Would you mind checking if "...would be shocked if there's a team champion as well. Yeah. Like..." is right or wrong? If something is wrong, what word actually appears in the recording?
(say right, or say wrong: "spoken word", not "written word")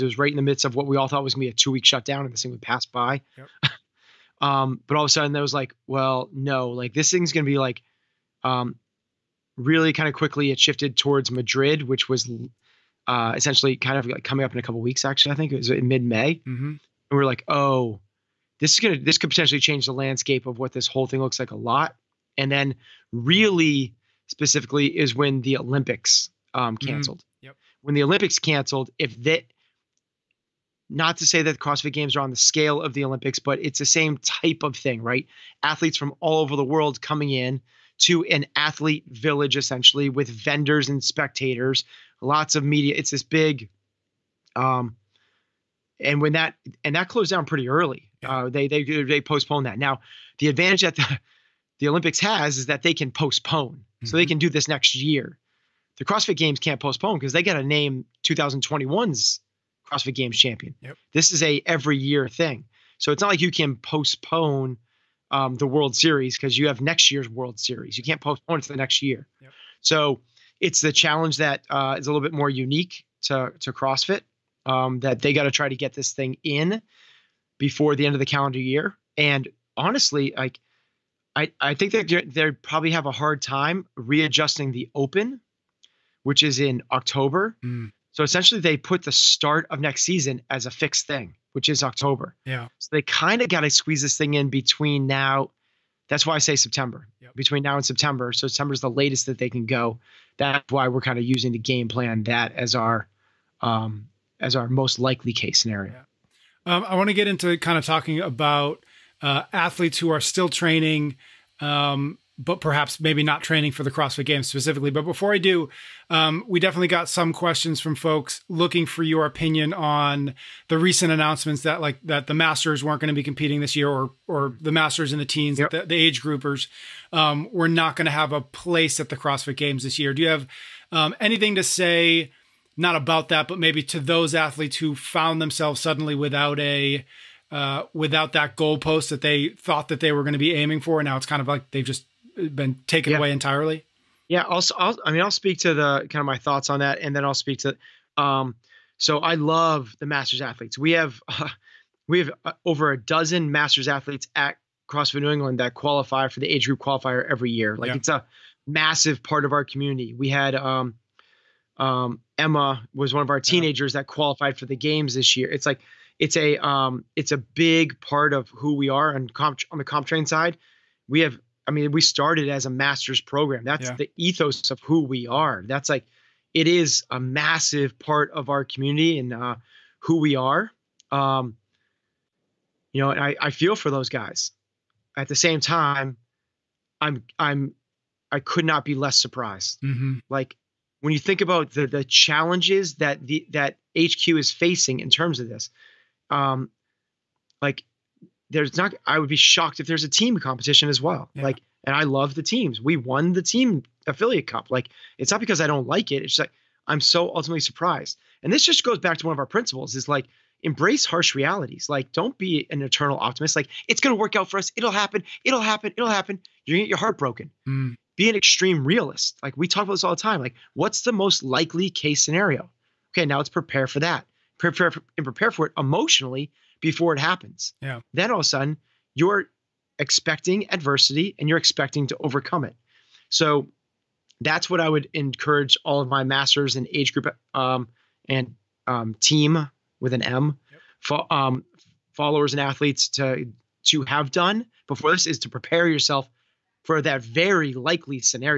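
wrong: "competition", not "champion".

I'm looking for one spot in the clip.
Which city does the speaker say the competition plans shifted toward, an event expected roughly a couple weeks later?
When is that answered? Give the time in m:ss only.
0:11.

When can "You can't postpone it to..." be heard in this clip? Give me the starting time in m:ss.
1:07.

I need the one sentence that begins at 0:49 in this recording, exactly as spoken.
Now, the advantage that the, the Olympics has is that they can postpone, mm-hmm.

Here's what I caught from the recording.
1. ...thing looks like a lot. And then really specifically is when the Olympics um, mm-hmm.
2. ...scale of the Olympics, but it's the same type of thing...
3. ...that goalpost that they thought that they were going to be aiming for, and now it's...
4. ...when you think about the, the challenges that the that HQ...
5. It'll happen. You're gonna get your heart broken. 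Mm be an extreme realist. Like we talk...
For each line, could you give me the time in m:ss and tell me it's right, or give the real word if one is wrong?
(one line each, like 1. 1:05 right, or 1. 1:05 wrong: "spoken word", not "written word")
1. 0:21 right
2. 0:32 right
3. 2:18 right
4. 3:11 right
5. 3:35 right.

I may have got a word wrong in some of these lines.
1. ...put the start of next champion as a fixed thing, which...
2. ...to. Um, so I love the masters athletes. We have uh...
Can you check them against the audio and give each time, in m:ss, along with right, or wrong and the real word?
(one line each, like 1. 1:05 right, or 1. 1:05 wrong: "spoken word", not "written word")
1. 1:28 wrong: "season", not "champion"
2. 2:27 right.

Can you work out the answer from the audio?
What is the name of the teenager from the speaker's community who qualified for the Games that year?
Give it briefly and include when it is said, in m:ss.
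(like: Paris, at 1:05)
Emma, at 2:42.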